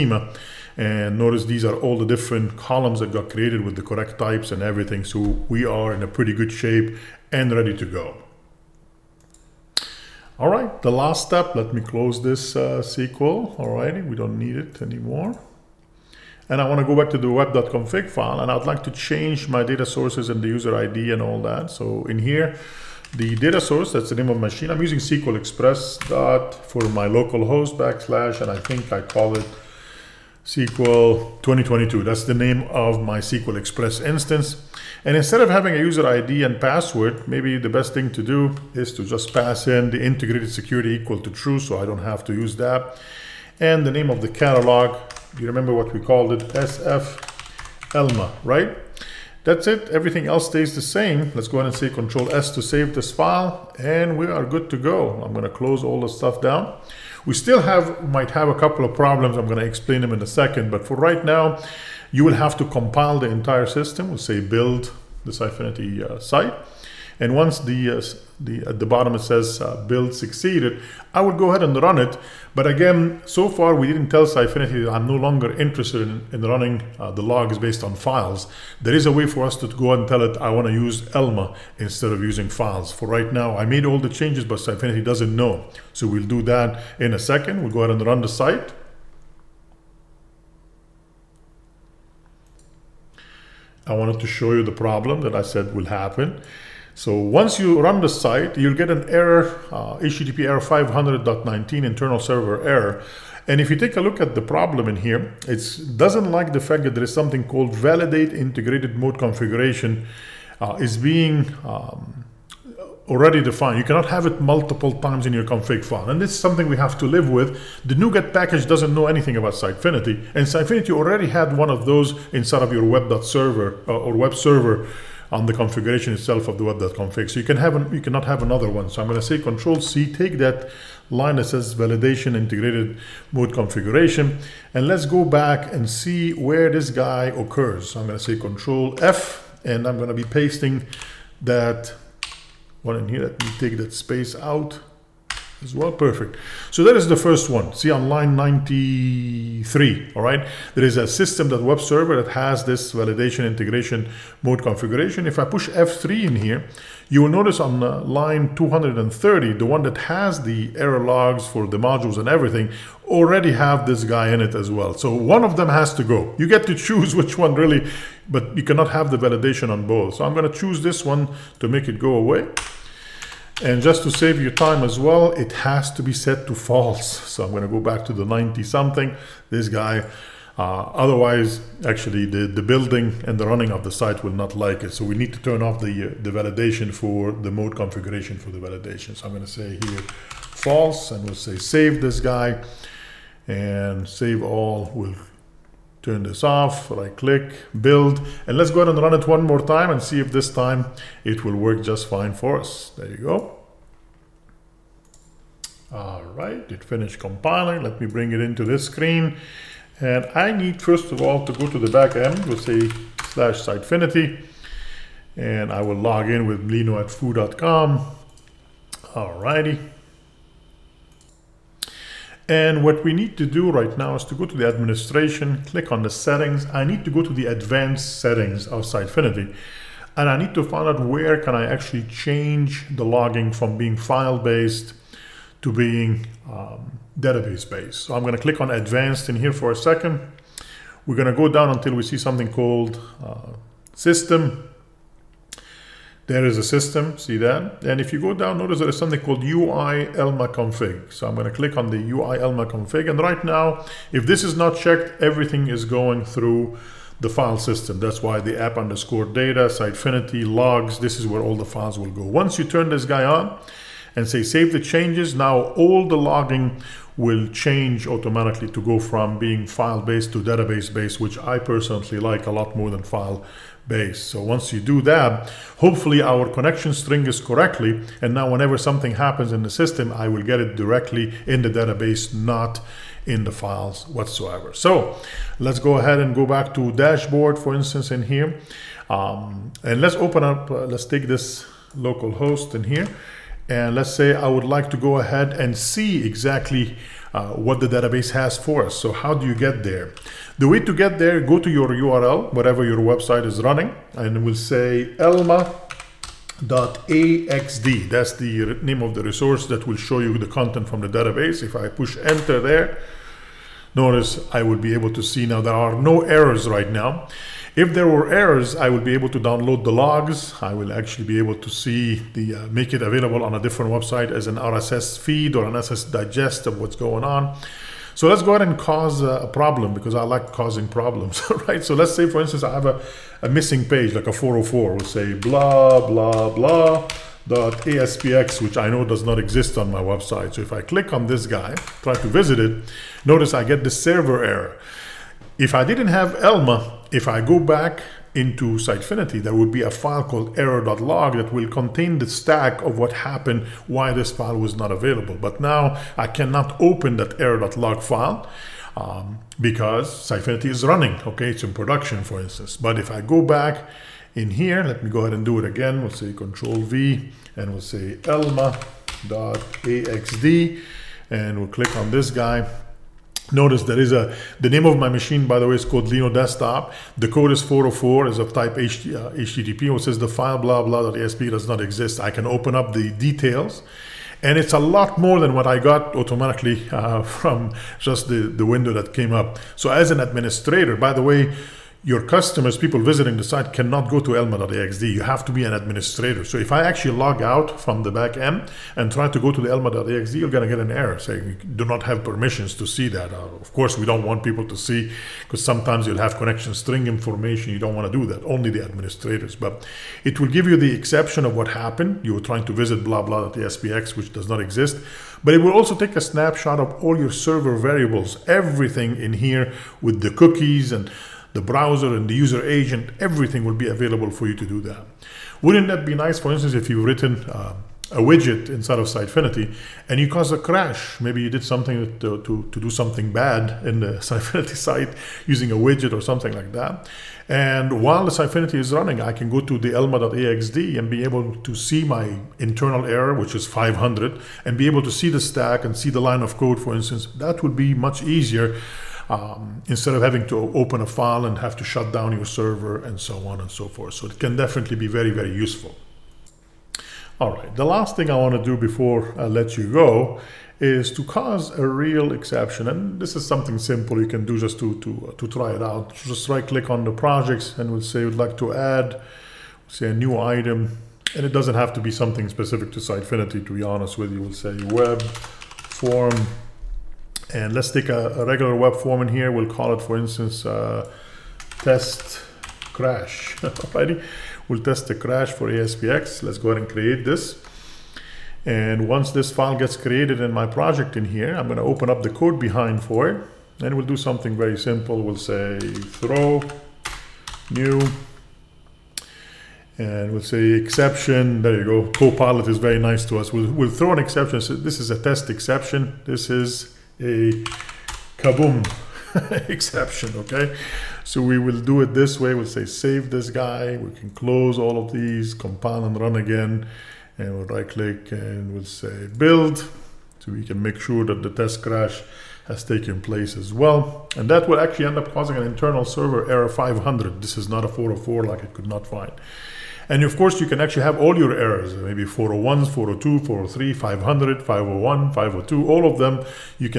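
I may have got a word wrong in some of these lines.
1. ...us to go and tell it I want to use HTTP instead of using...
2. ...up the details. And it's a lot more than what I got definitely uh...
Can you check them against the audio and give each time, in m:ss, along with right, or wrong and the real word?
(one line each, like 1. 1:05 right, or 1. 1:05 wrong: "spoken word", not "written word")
1. 1:19 wrong: "Elmah", not "HTTP"
2. 6:22 wrong: "automatically", not "definitely".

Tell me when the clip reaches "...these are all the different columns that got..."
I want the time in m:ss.
0:01.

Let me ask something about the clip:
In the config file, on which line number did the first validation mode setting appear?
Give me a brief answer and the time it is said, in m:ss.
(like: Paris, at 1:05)
93, at 2:28.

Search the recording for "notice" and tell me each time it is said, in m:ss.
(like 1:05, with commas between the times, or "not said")
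0:01, 2:37, 4:08, 5:13, 5:43, 6:13.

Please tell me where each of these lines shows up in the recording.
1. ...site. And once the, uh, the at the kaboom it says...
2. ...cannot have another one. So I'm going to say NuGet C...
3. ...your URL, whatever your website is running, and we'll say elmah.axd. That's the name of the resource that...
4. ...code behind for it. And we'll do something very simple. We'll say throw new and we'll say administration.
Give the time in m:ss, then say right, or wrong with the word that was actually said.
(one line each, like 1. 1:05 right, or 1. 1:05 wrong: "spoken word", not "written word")
1. 1:06 wrong: "bottom", not "kaboom"
2. 2:07 wrong: "Control", not "NuGet"
3. 5:01 right
4. 8:12 wrong: "exception", not "administration".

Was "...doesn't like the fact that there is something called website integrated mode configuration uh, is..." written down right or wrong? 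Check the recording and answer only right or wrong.
wrong.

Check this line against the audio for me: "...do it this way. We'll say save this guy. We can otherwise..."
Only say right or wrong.
wrong.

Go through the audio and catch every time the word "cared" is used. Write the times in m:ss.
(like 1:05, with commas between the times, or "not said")
not said.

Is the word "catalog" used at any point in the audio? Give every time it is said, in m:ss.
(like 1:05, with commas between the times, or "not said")
0:44.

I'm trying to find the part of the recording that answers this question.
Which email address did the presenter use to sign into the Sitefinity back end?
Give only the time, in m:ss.
3:36.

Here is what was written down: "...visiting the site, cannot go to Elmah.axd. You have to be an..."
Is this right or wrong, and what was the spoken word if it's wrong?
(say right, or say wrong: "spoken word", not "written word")
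right.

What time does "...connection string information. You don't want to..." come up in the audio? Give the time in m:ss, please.
6:46.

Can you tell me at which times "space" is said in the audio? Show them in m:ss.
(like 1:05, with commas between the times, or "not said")
2:23.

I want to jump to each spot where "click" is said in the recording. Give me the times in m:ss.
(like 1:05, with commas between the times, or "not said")
3:17, 3:45, 3:58, 4:11, 5:40, 6:11, 7:46, 8:37.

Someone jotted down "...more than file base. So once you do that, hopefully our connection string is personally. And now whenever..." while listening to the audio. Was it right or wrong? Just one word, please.
wrong.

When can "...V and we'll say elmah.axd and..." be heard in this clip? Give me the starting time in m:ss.
6:06.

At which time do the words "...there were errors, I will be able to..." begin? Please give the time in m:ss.
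5:17.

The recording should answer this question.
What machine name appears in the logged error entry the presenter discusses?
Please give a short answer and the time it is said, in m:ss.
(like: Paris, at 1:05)
Lino Desktop, at 6:16.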